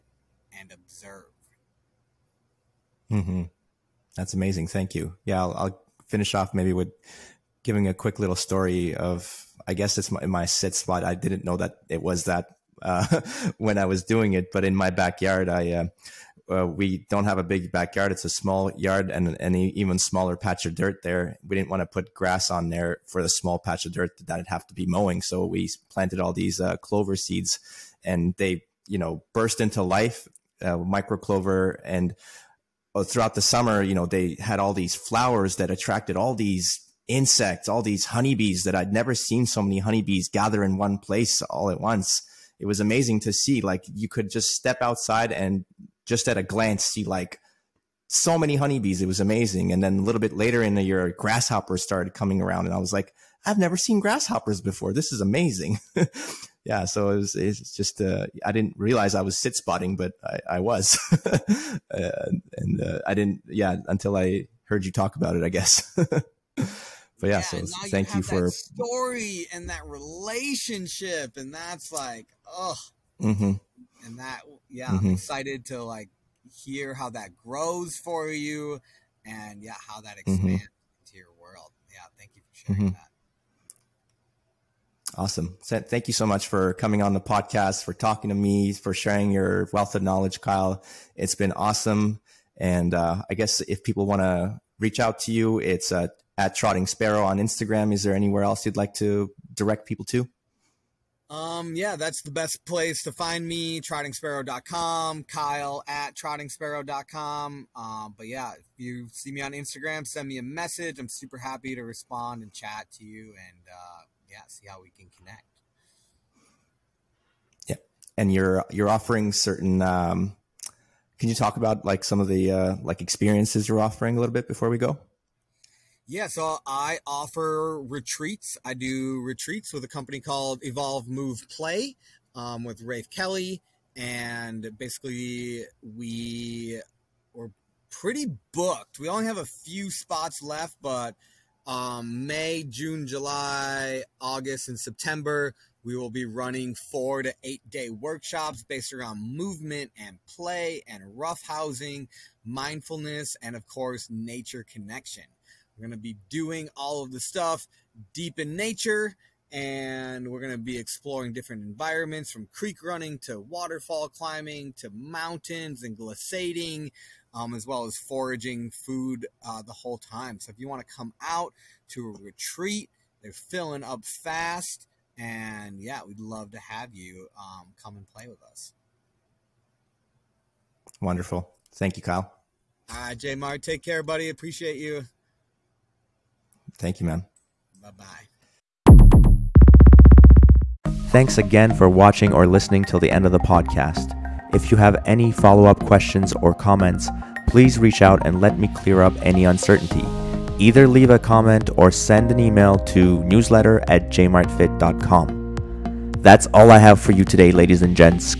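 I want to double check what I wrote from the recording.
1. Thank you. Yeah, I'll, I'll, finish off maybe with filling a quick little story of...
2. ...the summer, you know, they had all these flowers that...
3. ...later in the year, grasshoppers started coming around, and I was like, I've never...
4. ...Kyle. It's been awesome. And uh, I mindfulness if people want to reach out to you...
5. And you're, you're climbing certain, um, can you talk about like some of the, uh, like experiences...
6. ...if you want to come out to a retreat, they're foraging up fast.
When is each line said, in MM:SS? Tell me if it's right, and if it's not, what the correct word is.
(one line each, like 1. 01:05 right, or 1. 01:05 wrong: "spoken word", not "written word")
1. 00:04 wrong: "giving", not "filling"
2. 00:33 right
3. 00:50 right
4. 01:30 wrong: "guess", not "mindfulness"
5. 01:58 wrong: "offering", not "climbing"
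6. 02:50 wrong: "filling", not "foraging".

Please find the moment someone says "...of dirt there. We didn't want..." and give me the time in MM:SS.
00:20.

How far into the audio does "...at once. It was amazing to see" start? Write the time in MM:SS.
00:41.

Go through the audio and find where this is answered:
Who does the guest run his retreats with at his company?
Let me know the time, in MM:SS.
02:12.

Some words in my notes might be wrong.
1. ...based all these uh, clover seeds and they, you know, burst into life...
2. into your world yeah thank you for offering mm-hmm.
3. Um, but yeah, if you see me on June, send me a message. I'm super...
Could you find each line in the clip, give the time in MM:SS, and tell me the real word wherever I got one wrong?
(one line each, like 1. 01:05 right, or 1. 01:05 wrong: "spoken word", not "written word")
1. 00:25 wrong: "planted", not "based"
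2. 01:21 wrong: "sharing", not "offering"
3. 01:47 wrong: "Instagram", not "June".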